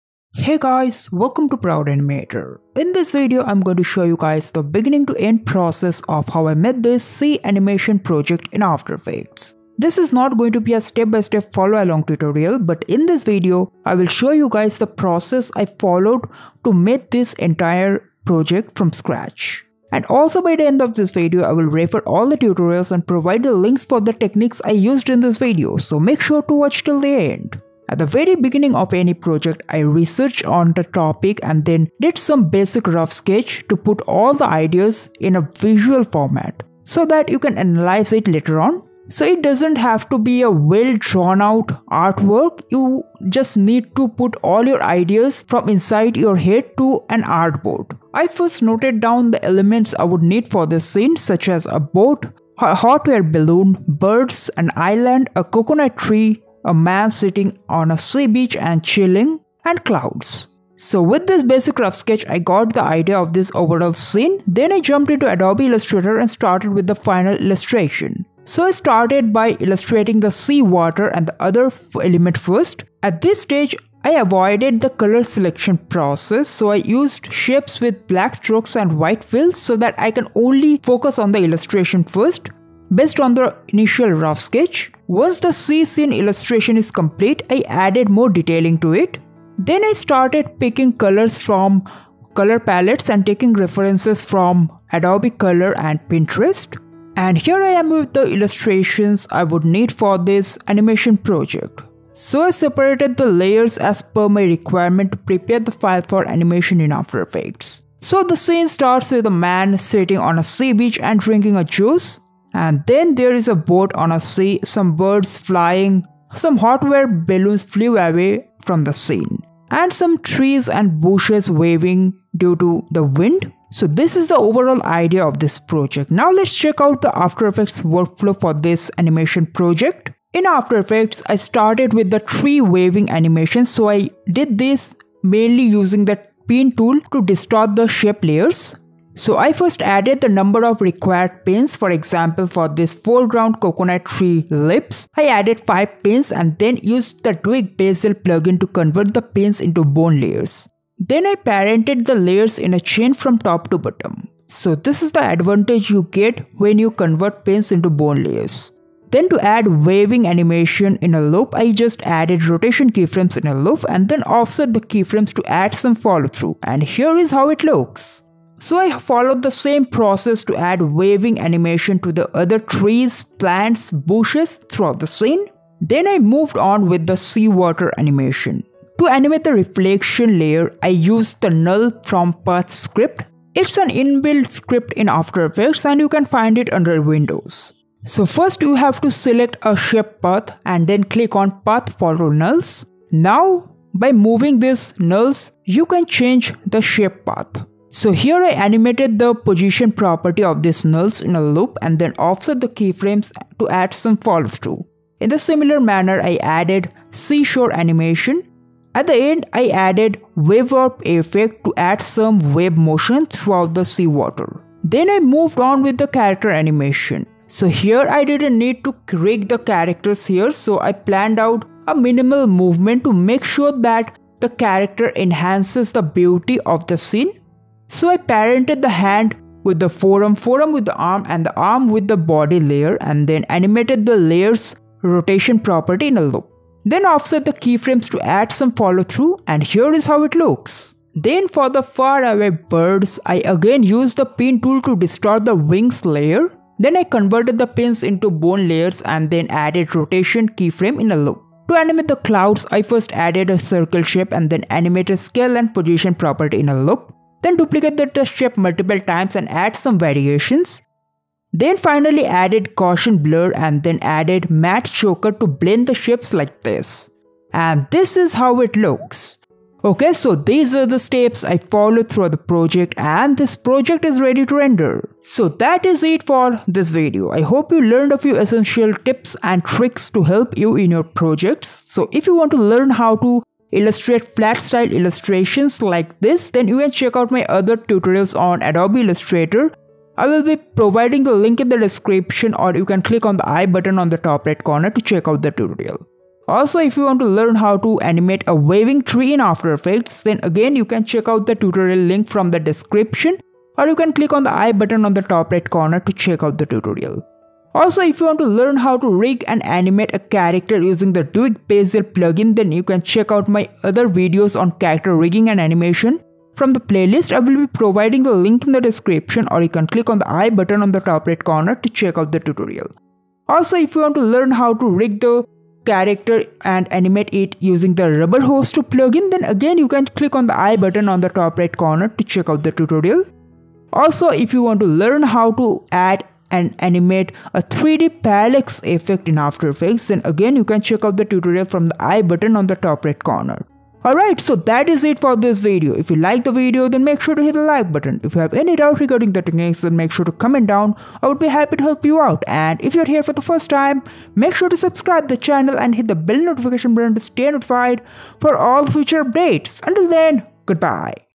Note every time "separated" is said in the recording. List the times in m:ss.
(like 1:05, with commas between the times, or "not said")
1:42.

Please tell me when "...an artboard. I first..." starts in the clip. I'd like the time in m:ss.
0:47.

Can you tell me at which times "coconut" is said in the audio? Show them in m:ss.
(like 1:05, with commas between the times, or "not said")
0:55, 2:23.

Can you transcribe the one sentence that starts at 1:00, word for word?
So with this basic rough sketch, I got the idea of this overall scene.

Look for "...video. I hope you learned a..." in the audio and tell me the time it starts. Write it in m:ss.
4:36.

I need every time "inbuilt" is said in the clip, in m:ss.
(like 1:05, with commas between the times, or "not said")
3:03.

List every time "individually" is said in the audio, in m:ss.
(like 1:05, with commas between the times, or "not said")
not said.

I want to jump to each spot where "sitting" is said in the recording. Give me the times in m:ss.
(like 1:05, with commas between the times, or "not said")
0:57, 1:49.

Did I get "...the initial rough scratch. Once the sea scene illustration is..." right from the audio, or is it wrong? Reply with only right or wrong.
wrong.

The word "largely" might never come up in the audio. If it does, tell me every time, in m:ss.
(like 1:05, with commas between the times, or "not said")
not said.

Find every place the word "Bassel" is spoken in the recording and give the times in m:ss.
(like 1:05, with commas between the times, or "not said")
2:27, 5:11.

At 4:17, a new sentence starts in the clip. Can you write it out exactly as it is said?
Then duplicate the test shape multiple times and add some variations.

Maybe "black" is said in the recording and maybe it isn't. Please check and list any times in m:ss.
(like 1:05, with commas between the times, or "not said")
1:18.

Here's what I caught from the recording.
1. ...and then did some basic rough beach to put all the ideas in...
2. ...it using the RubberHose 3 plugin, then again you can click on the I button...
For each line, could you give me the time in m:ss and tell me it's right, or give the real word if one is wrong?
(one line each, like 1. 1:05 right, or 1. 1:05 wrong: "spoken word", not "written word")
1. 0:31 wrong: "sketch", not "beach"
2. 5:27 wrong: "2", not "3".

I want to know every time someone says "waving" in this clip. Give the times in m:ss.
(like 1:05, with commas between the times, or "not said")
2:01, 2:12, 2:39, 2:50, 4:58.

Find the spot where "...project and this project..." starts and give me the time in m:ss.
4:32.